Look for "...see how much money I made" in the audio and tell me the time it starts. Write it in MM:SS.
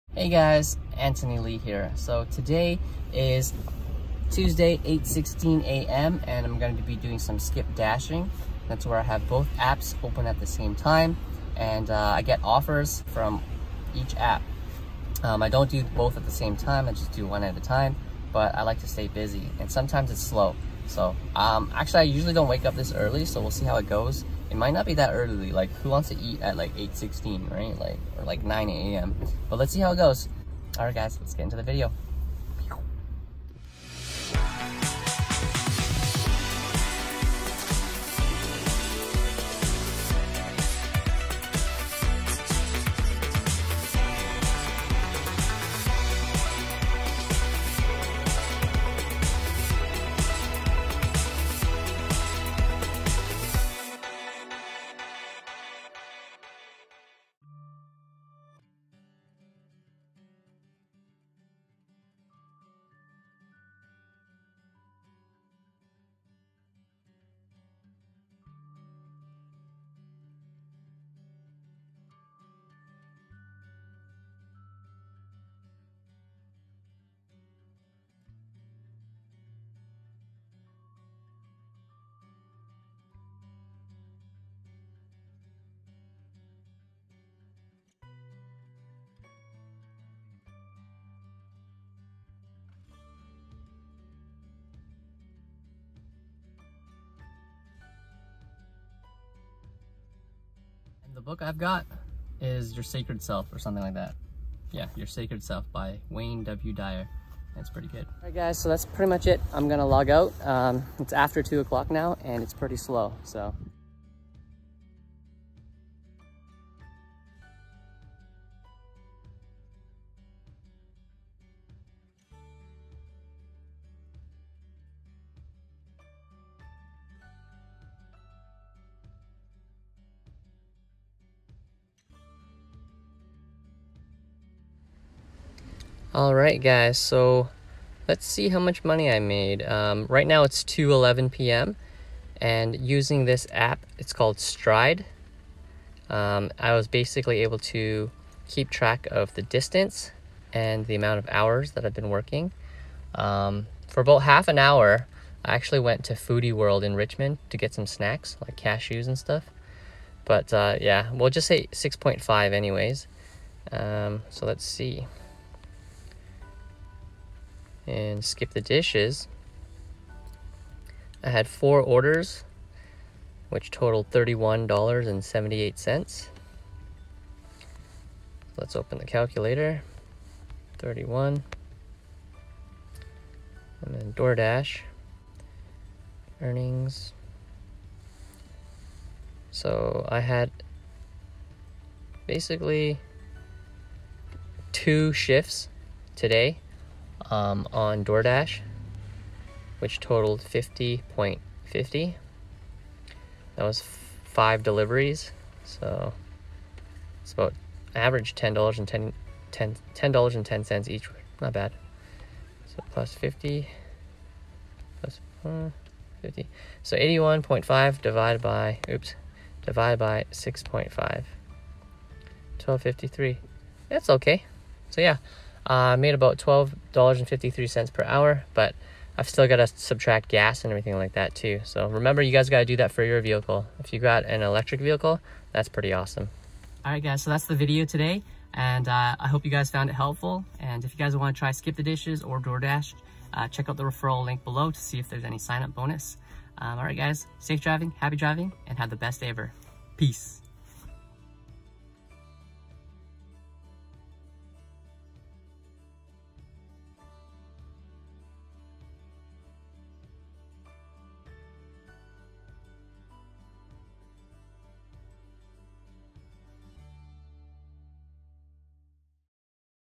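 02:18.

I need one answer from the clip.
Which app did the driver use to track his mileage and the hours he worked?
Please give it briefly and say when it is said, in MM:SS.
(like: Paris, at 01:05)
Stride, at 02:23.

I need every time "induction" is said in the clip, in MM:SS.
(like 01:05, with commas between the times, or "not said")
not said.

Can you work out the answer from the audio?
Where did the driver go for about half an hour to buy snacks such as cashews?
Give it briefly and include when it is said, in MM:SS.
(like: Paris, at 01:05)
Foodie World, at 02:36.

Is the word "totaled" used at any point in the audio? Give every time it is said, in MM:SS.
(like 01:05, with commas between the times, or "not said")
02:53, 03:19.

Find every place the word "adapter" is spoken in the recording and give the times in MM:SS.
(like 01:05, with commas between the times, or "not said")
not said.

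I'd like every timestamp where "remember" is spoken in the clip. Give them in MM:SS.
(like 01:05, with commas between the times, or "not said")
03:51.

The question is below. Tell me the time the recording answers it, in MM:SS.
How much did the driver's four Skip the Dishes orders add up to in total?
02:54.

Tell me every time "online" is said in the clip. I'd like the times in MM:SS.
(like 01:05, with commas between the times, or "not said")
not said.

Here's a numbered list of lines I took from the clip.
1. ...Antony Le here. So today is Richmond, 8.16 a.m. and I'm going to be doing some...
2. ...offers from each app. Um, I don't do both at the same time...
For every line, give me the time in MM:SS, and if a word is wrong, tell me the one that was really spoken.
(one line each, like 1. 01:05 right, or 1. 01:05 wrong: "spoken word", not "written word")
1. 00:00 wrong: "Tuesday", not "Richmond"
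2. 00:12 right.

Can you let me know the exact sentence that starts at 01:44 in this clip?
Yeah, Your Sacred Self by Wayne W.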